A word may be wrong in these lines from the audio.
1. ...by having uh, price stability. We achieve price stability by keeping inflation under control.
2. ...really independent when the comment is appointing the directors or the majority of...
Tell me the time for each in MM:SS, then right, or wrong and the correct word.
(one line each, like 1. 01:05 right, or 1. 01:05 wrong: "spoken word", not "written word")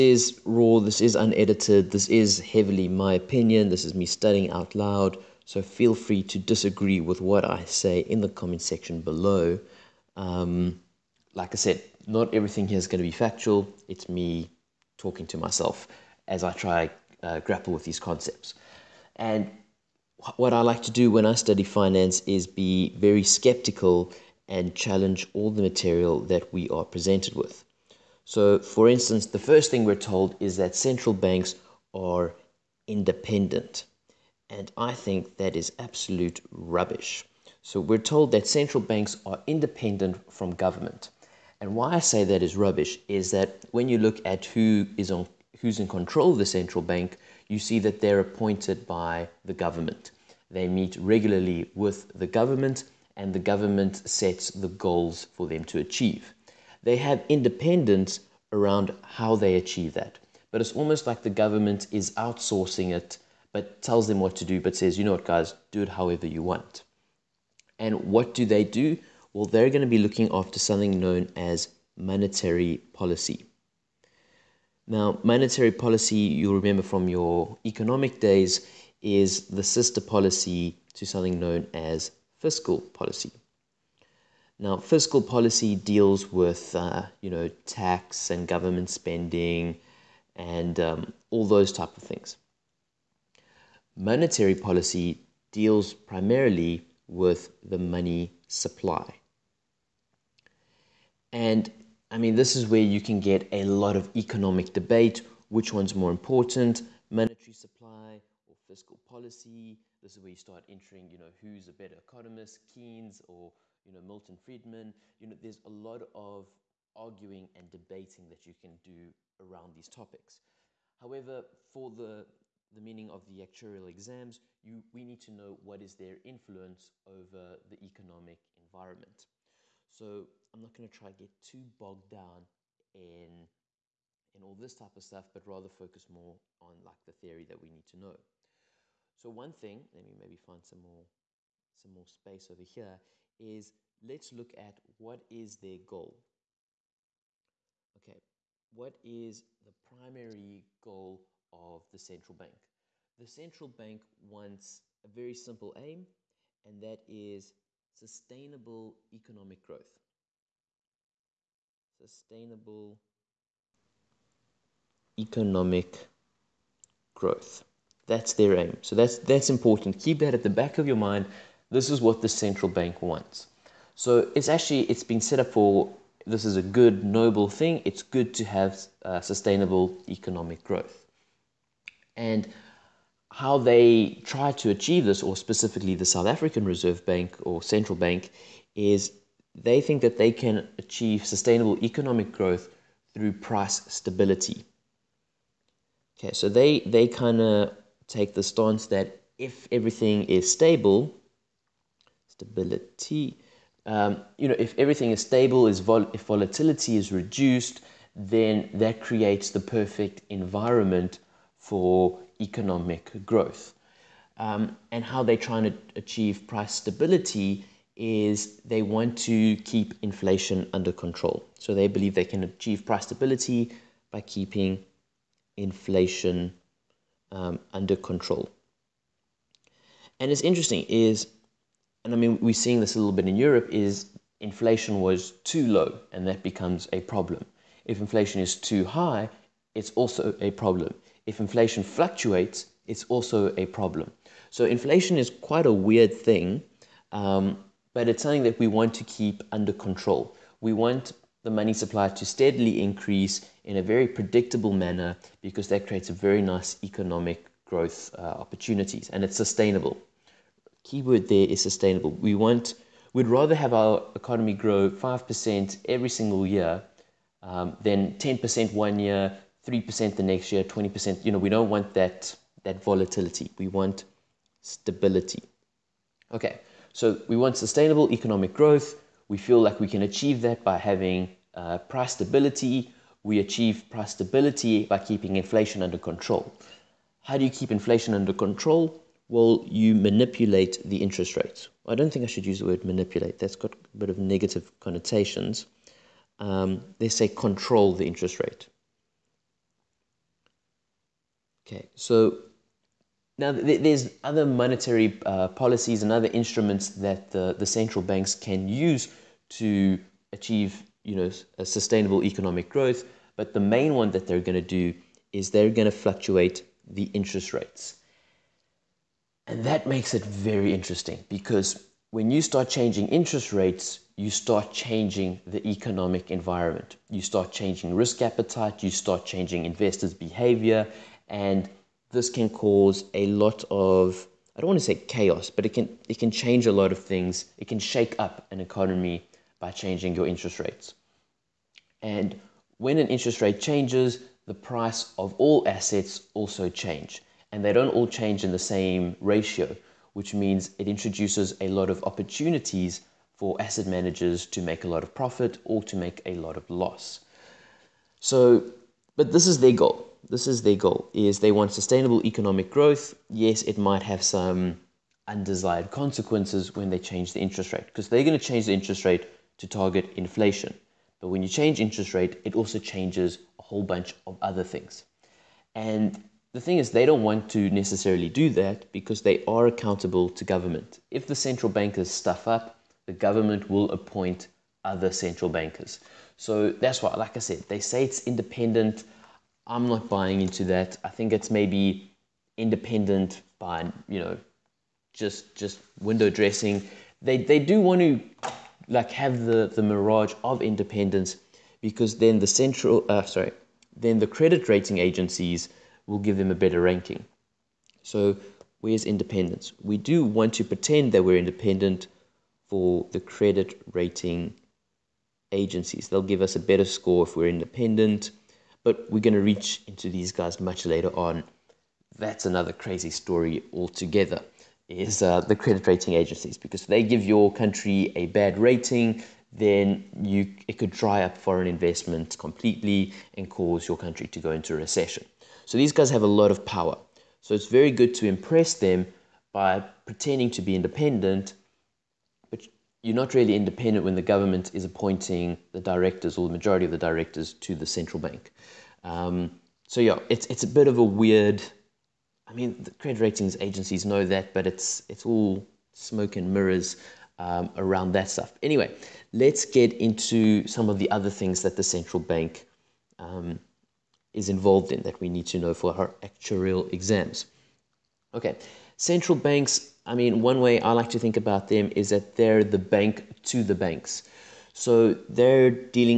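1. 04:40 right
2. 07:23 wrong: "government", not "comment".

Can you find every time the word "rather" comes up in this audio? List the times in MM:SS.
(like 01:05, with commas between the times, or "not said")
02:15, 04:23.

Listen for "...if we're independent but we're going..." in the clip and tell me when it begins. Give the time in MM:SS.
06:57.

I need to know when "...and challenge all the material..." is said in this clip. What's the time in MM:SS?
00:24.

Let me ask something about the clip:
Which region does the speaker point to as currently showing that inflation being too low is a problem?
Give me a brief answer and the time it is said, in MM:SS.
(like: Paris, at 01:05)
Europe, at 03:53.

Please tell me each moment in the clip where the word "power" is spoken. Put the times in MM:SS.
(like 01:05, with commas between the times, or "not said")
07:16.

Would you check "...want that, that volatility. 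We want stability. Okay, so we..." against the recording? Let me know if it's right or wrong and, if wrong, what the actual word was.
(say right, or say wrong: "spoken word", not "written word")
right.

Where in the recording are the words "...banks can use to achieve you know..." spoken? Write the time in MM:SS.
05:08.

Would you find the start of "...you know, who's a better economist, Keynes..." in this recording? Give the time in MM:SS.
01:51.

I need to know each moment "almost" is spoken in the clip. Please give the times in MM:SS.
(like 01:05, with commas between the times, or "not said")
01:00.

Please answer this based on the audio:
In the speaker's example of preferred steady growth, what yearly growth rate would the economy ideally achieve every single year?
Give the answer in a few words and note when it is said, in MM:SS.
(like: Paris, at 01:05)
5%, at 04:24.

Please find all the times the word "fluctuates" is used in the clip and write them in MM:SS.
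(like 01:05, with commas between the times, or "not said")
04:01, 05:16.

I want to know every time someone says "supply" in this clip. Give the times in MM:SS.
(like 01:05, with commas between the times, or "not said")
01:38, 01:47, 04:11.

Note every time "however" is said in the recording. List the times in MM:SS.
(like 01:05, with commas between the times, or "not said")
01:05, 02:00.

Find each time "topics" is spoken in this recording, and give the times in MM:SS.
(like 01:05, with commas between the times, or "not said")
01:59.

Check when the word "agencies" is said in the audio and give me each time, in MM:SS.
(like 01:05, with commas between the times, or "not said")
06:44, 06:55, 07:06, 07:33.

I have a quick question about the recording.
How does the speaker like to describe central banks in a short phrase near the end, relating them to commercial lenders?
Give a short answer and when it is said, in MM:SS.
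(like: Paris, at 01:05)
The bank to the banks, at 07:52.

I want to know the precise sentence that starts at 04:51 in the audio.
I don't think I should use the word manipulate, that's got a bit of negative connotations.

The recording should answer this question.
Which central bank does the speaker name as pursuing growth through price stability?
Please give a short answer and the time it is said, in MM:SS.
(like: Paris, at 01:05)
South African Reserve Bank, at 03:06.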